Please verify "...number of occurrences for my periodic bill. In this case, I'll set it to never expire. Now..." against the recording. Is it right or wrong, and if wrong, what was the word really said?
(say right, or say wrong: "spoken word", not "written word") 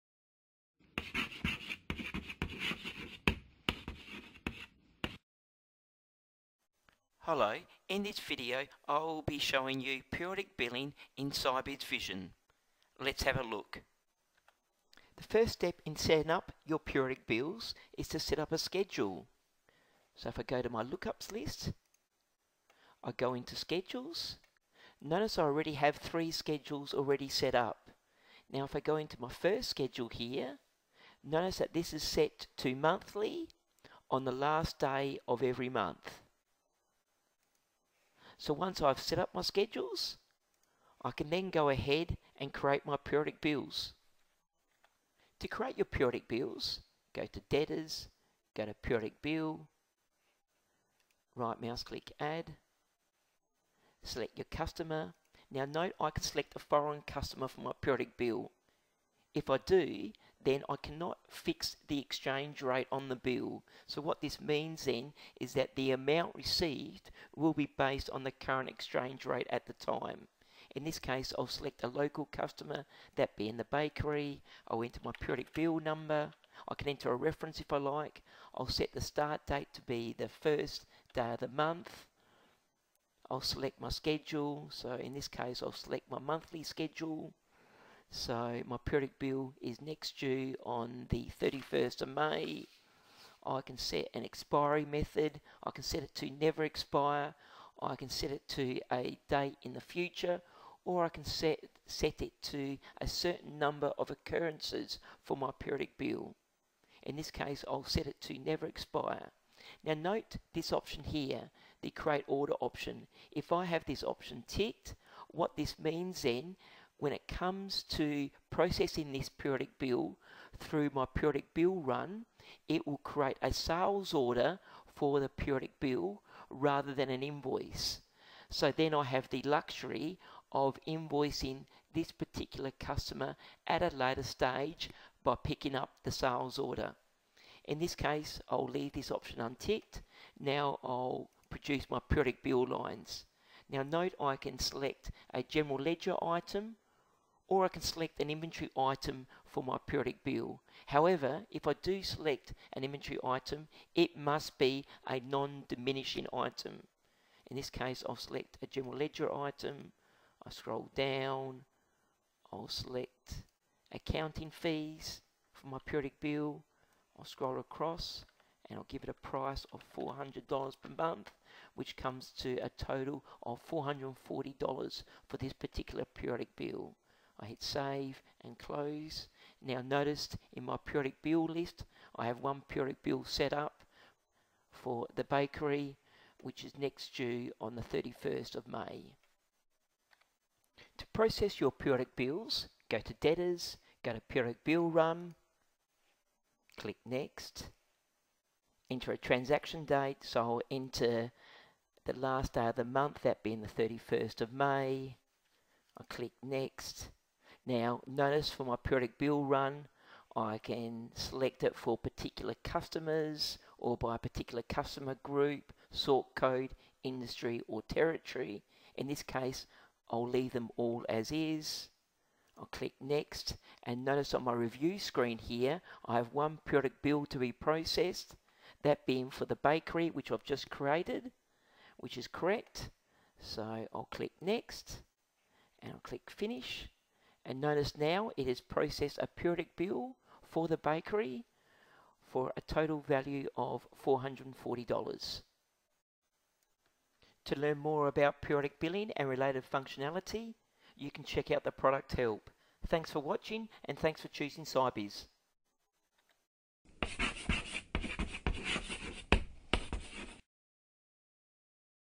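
right.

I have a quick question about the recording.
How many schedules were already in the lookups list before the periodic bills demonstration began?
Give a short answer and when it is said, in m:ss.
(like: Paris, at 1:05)
3, at 0:25.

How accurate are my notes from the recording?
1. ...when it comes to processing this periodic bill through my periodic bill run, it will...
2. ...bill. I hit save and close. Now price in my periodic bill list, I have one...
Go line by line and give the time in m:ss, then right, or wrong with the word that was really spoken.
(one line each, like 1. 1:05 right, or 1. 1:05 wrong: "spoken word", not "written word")
1. 1:57 right
2. 2:56 wrong: "notice", not "price".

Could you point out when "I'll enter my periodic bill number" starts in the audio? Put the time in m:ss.
1:14.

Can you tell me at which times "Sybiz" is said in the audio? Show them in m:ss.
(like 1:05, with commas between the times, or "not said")
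0:11, 4:14.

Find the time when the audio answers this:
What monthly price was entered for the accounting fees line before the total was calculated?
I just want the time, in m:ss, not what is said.
2:49.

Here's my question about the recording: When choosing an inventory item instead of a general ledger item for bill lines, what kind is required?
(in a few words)
non-diminishing.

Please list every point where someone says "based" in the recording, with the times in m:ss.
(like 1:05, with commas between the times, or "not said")
1:07.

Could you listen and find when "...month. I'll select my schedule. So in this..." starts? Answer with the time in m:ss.
1:21.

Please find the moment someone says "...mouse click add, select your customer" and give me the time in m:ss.
0:51.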